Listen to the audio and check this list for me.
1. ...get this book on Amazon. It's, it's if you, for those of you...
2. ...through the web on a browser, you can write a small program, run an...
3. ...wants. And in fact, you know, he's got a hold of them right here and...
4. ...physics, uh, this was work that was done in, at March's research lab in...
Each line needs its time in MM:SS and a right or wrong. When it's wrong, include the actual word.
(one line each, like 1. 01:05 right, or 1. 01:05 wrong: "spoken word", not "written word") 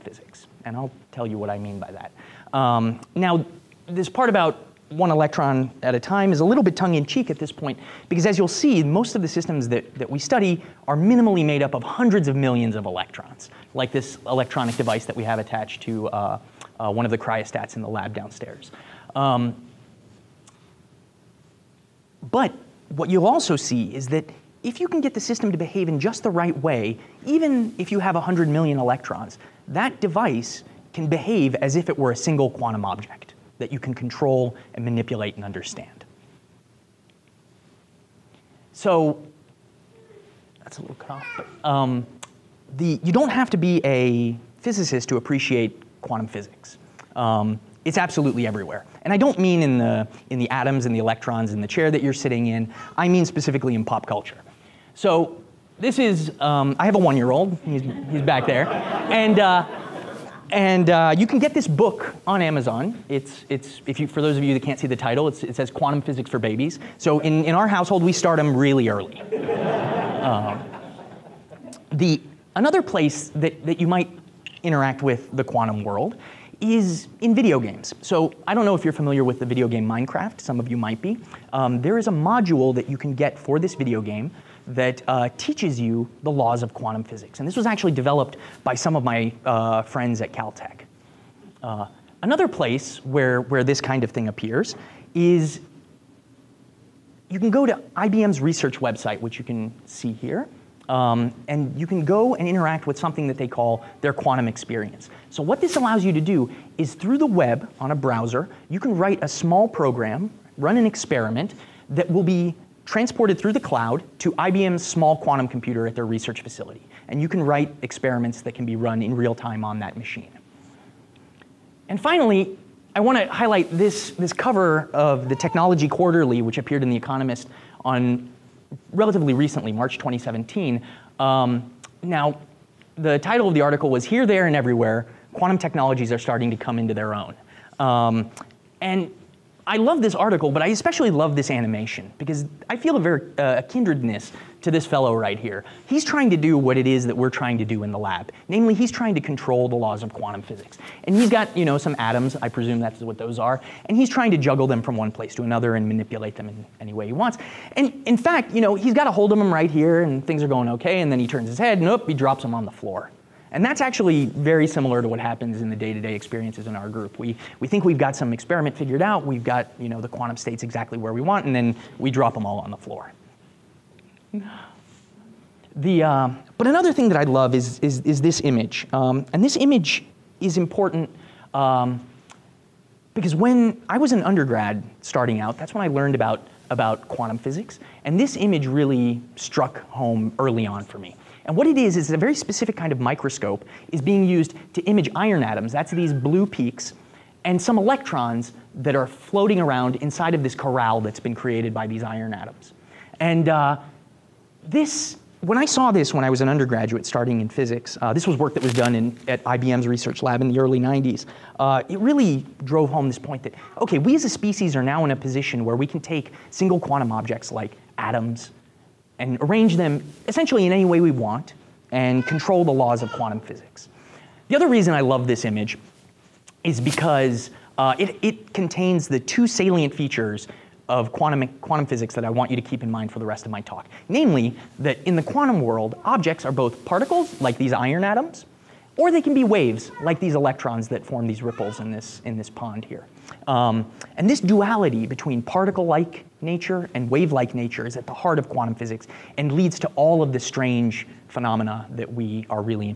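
1. 01:01 right
2. 01:46 right
3. 02:37 right
4. 03:27 wrong: "IBM", not "March".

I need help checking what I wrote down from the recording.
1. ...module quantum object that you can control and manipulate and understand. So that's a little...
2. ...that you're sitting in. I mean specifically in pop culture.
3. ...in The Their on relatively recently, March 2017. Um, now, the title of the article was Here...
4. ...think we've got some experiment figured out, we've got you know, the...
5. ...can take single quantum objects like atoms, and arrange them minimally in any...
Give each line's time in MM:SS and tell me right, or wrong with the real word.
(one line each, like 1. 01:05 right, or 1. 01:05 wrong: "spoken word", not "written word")
1. 00:32 wrong: "single", not "module"
2. 00:51 right
3. 02:06 wrong: "Economist", not "Their"
4. 02:47 right
5. 03:35 wrong: "essentially", not "minimally".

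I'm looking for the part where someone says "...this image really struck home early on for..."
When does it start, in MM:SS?
03:08.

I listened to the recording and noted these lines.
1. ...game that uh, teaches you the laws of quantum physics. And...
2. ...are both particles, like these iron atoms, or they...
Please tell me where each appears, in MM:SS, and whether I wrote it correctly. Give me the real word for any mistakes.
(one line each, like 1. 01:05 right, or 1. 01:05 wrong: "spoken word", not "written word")
1. 01:24 right
2. 03:56 right.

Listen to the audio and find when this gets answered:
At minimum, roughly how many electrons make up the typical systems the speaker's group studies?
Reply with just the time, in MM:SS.
00:11.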